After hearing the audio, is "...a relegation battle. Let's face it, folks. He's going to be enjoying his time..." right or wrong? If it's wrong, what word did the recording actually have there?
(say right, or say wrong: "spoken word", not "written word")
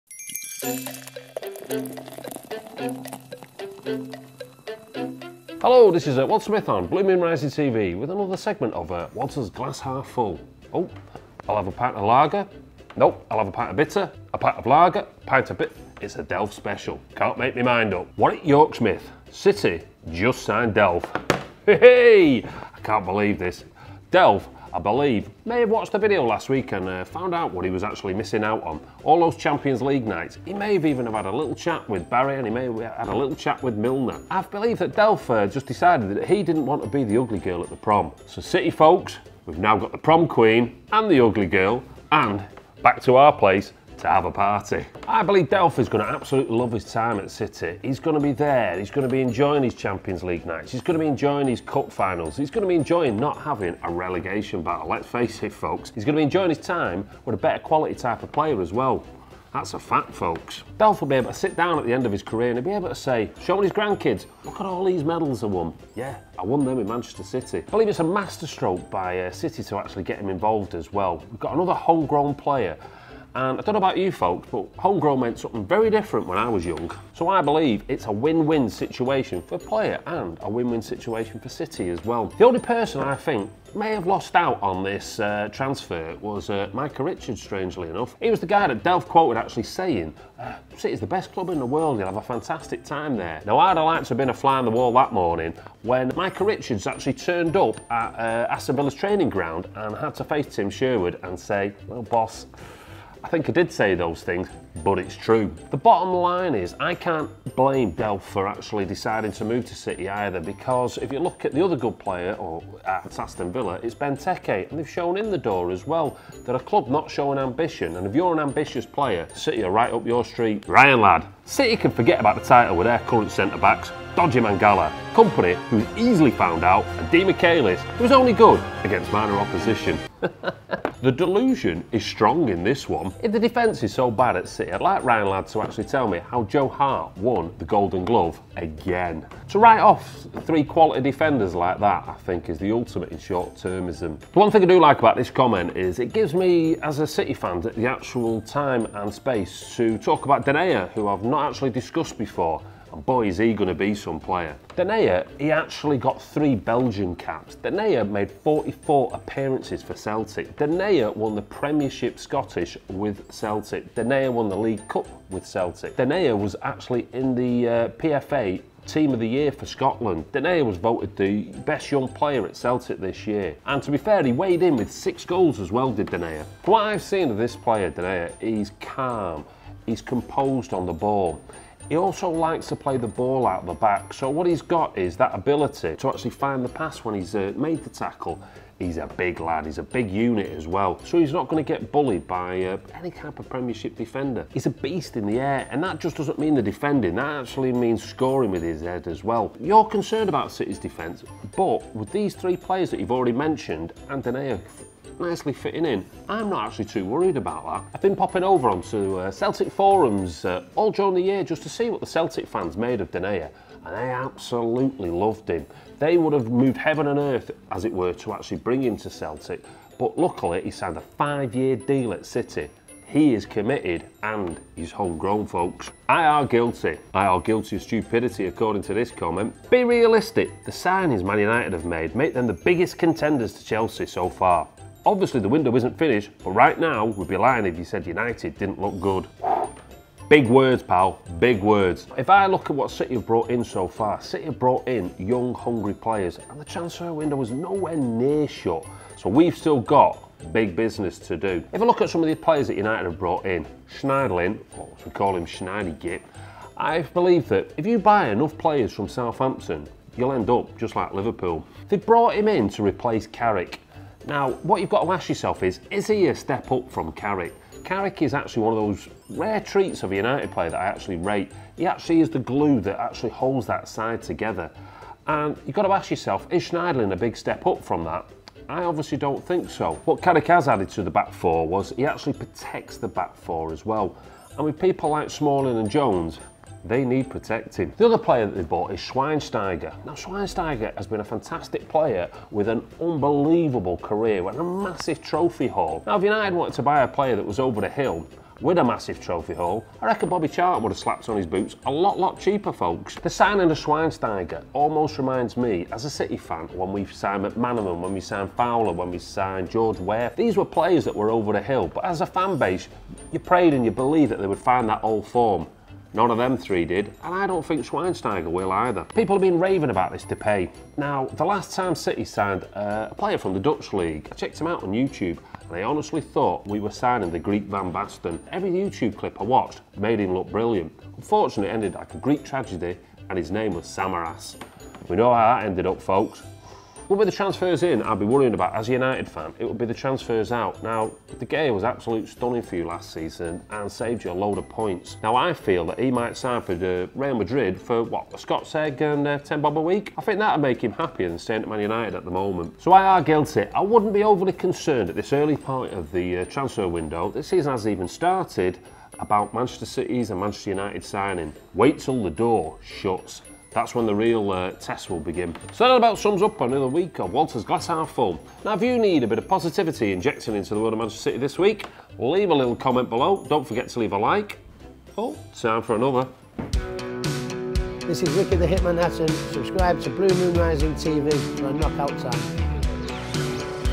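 right.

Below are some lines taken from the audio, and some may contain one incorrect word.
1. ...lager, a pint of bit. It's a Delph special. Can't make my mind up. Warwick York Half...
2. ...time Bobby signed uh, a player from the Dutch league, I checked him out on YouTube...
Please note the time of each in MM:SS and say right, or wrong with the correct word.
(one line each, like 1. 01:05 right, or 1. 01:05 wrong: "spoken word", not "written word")
1. 00:14 wrong: "Smith", not "Half"
2. 05:21 wrong: "City", not "Bobby".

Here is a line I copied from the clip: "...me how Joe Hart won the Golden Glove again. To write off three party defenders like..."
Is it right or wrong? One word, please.
wrong.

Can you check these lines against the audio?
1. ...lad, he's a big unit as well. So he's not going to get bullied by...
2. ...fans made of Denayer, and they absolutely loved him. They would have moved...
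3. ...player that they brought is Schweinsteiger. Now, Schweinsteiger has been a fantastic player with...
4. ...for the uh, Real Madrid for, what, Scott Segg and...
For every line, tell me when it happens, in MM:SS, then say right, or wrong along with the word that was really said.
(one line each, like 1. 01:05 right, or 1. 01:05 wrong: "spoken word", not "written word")
1. 03:09 right
2. 03:32 right
3. 04:48 wrong: "bought", not "brought"
4. 05:46 right.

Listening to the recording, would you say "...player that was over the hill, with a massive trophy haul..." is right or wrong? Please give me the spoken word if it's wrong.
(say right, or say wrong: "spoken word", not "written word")
right.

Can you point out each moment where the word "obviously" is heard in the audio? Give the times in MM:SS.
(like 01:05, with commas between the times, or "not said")
03:55, 04:38.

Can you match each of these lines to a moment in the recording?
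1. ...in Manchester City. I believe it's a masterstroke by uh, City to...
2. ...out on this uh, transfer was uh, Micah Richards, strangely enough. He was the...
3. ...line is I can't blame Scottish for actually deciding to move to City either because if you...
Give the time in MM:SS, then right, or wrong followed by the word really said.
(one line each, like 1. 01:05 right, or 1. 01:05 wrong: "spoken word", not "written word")
1. 01:06 right
2. 01:24 right
3. 01:46 wrong: "Delph", not "Scottish".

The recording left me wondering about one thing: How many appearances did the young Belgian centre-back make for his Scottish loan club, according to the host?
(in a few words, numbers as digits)
44.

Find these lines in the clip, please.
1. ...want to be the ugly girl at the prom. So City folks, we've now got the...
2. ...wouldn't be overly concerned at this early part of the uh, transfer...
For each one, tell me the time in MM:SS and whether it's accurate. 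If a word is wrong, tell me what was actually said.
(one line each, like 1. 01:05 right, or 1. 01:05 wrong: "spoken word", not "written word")
1. 00:36 right
2. 05:53 right.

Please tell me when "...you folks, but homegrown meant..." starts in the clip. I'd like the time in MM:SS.
01:13.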